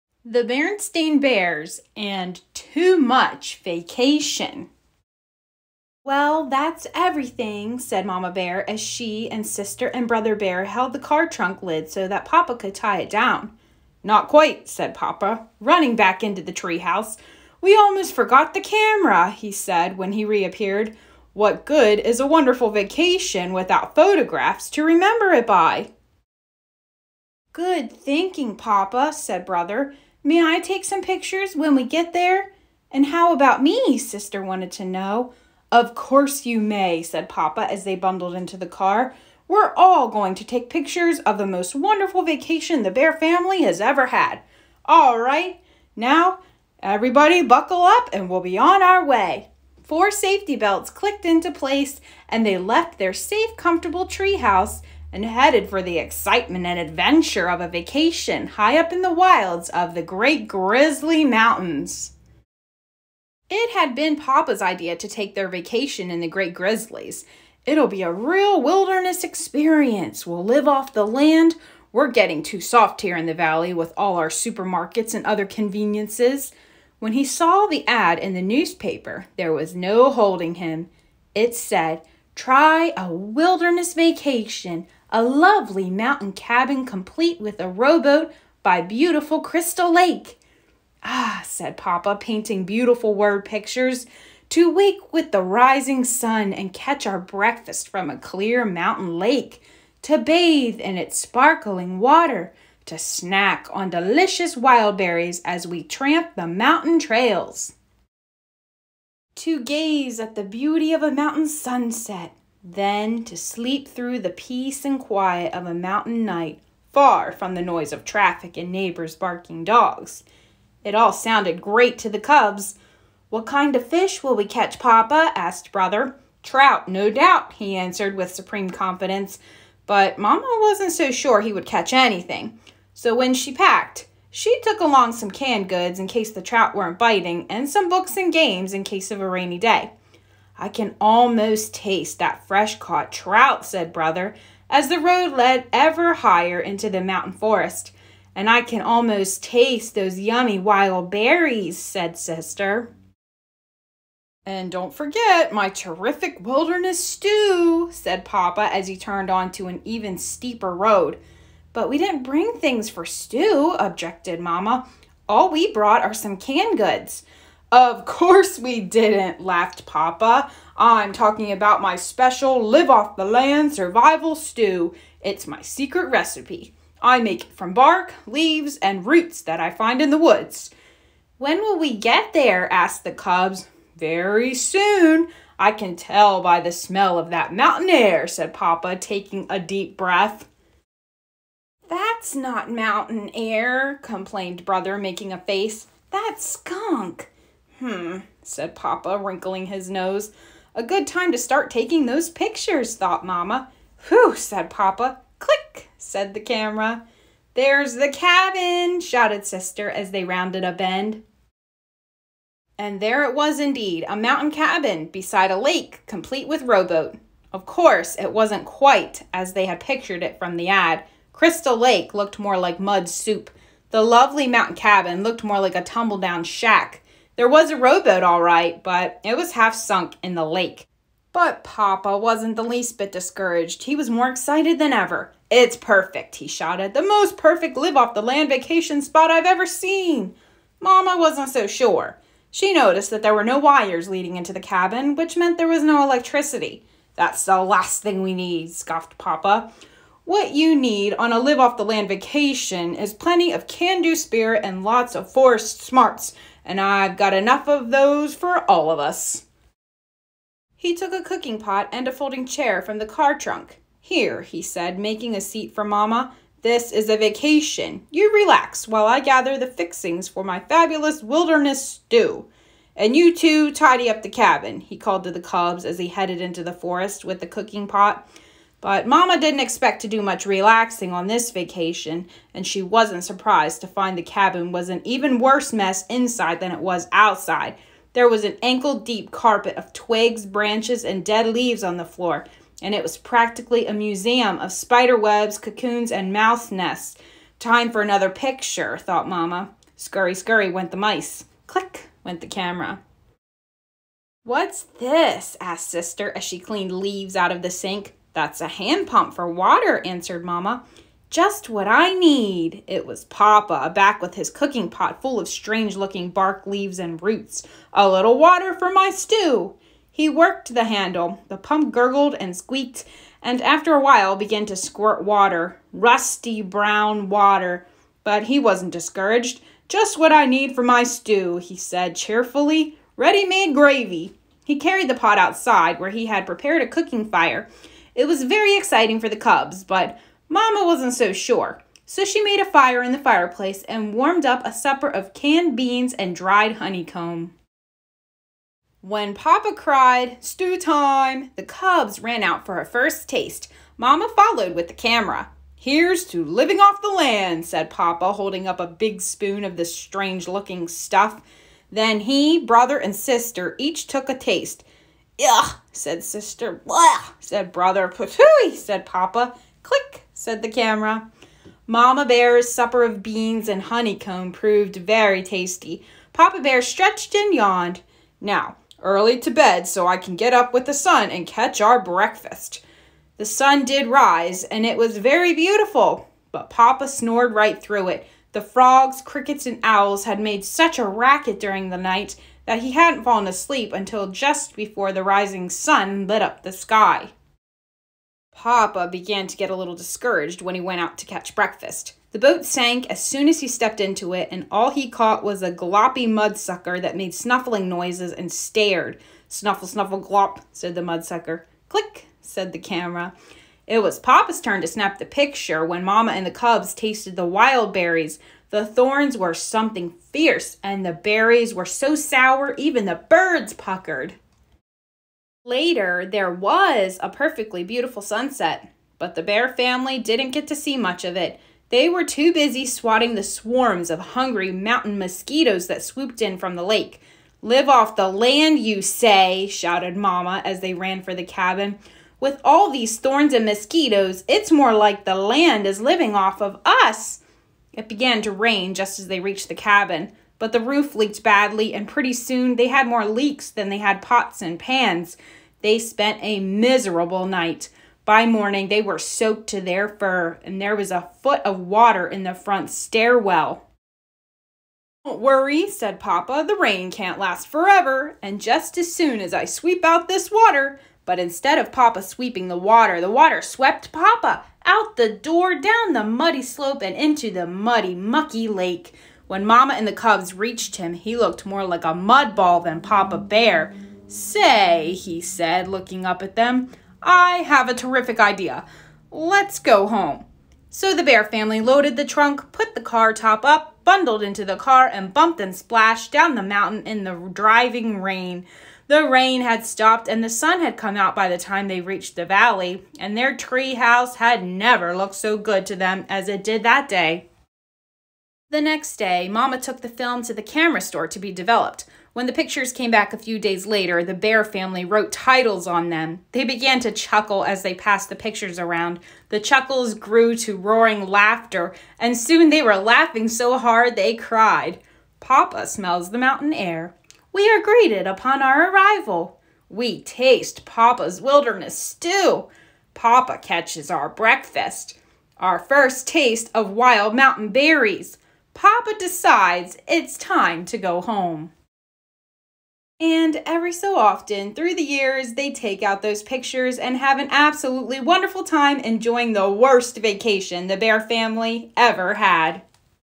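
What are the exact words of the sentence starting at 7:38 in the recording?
By morning, they were soaked to their fur, and there was a foot of water in the front stairwell.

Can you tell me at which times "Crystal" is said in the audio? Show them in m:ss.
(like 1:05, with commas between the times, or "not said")
1:29, 3:41.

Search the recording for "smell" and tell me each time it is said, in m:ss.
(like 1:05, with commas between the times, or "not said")
3:06, 8:45.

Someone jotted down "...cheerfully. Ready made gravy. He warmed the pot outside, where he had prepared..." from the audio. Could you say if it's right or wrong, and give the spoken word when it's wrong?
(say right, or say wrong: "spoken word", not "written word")
wrong: "carried", not "warmed".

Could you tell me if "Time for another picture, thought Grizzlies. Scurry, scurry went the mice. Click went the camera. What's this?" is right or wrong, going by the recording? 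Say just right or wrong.
wrong.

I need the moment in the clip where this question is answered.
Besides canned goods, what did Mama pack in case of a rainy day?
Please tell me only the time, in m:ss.
2:17.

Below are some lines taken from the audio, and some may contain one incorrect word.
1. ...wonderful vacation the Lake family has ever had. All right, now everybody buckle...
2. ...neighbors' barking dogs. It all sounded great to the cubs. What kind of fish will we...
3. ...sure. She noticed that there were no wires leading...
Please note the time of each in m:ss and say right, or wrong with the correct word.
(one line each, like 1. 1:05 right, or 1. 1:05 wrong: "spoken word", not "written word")
1. 0:41 wrong: "Bear", not "Lake"
2. 1:58 right
3. 4:01 right.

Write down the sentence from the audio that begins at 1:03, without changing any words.
It had been Papa's idea to take their vacation in the Great Grizzlies.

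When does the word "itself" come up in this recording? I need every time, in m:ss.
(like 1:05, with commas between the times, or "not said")
not said.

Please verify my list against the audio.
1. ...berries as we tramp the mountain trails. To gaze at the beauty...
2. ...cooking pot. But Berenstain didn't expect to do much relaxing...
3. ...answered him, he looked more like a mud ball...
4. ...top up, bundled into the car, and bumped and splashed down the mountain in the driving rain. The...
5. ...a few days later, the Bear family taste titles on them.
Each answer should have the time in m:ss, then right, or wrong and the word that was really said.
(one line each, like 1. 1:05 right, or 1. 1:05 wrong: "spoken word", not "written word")
1. 1:44 right
2. 4:37 wrong: "Mama", not "Berenstain"
3. 8:00 wrong: "reached", not "answered"
4. 8:13 right
5. 8:33 wrong: "wrote", not "taste".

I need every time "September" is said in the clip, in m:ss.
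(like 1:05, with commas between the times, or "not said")
not said.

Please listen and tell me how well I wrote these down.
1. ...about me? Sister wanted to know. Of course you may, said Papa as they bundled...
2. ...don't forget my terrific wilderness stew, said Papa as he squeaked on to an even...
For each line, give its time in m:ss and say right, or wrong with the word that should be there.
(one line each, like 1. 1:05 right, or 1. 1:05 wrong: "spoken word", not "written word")
1. 0:33 right
2. 2:34 wrong: "turned", not "squeaked".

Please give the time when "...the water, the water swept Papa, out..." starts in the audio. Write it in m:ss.
7:52.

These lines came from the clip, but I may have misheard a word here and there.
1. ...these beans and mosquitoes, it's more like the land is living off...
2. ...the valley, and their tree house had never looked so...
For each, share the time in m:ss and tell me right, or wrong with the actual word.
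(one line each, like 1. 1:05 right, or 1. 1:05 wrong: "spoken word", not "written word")
1. 7:22 wrong: "thorns", not "beans"
2. 8:22 right.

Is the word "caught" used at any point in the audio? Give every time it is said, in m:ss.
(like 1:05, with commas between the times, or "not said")
2:22, 6:45.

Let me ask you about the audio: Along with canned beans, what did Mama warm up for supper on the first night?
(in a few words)
dried honeycomb.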